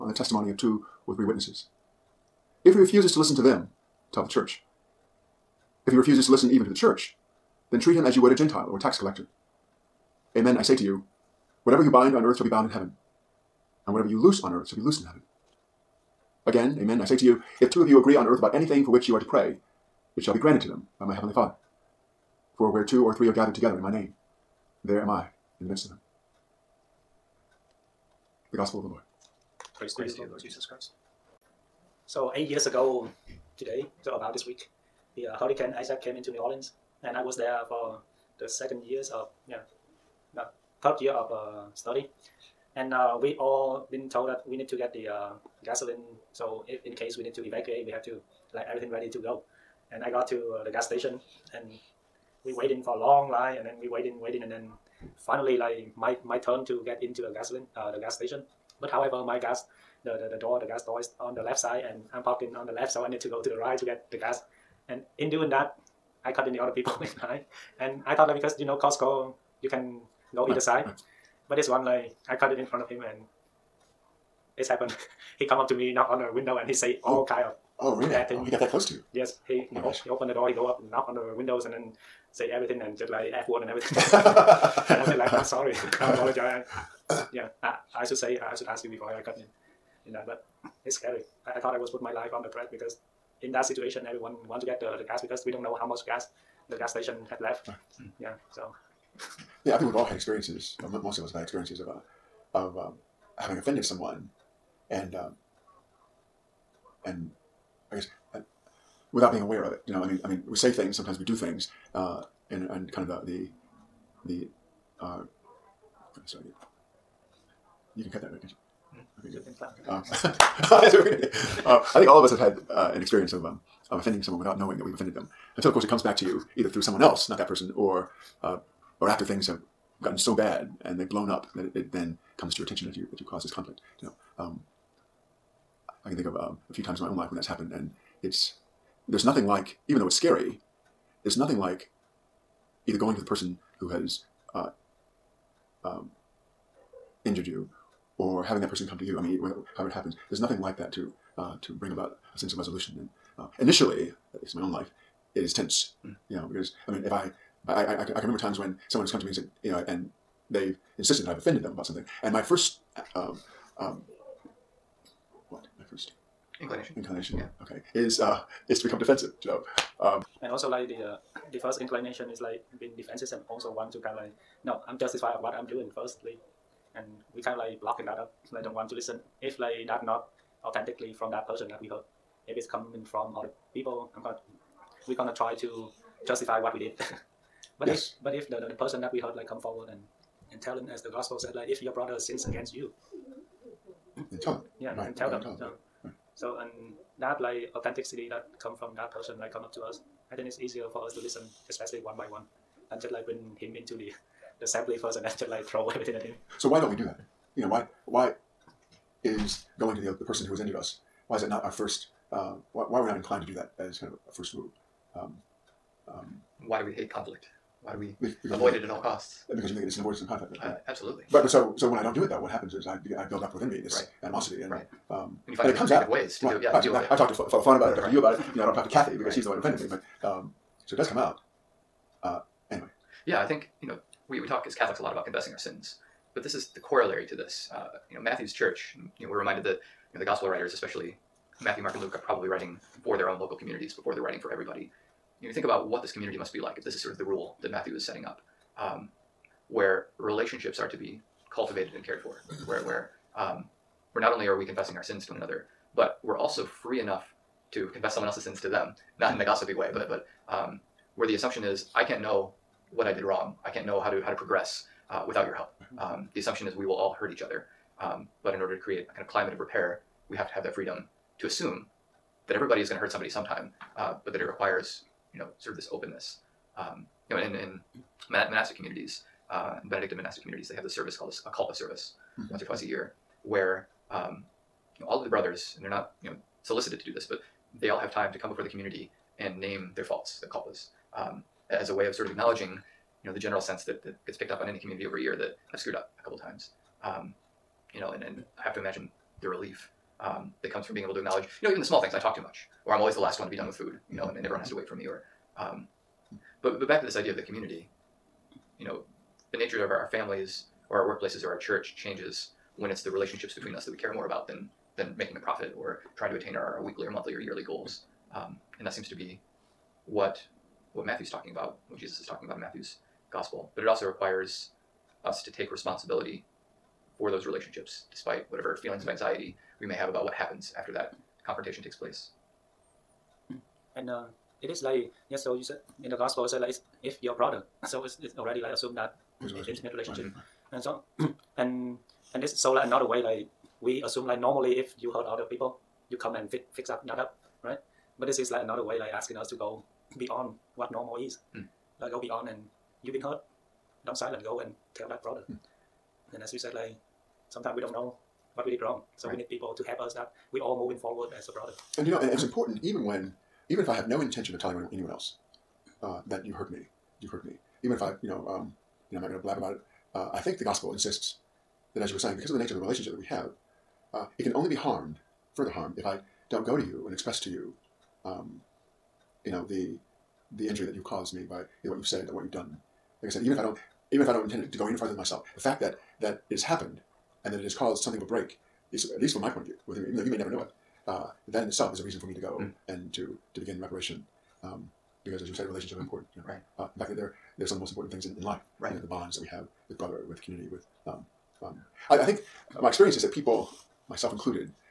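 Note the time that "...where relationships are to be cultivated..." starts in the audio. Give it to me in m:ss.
4:09.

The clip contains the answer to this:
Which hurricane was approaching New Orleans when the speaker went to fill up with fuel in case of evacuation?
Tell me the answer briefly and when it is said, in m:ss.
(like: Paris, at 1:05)
Hurricane Isaac, at 0:35.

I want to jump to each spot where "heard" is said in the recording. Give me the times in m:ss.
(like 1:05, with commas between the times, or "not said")
3:01, 3:09.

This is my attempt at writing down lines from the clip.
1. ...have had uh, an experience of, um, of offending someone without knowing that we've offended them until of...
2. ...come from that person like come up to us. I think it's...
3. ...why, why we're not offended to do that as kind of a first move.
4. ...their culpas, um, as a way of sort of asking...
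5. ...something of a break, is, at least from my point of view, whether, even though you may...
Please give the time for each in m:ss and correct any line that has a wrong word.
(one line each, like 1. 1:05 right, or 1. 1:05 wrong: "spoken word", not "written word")
1. 2:02 right
2. 3:18 right
3. 3:32 wrong: "inclined", not "offended"
4. 4:50 wrong: "acknowledging", not "asking"
5. 6:28 right.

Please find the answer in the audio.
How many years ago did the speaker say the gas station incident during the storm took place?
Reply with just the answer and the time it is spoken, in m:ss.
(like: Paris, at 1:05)
8, at 0:32.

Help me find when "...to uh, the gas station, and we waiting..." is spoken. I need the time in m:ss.
0:50.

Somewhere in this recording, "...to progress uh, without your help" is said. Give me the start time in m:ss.
4:24.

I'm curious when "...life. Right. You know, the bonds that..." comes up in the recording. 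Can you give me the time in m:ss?
6:38.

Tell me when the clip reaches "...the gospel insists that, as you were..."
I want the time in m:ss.
6:10.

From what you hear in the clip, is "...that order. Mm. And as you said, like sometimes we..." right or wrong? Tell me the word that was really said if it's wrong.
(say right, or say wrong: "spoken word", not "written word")
wrong: "brother", not "order".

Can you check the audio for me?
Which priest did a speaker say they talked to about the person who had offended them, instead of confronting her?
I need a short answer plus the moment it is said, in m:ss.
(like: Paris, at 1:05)
Father Fawn, at 3:47.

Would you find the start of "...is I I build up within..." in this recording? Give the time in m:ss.
3:42.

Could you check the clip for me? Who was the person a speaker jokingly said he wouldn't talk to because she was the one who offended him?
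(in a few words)
Kathy.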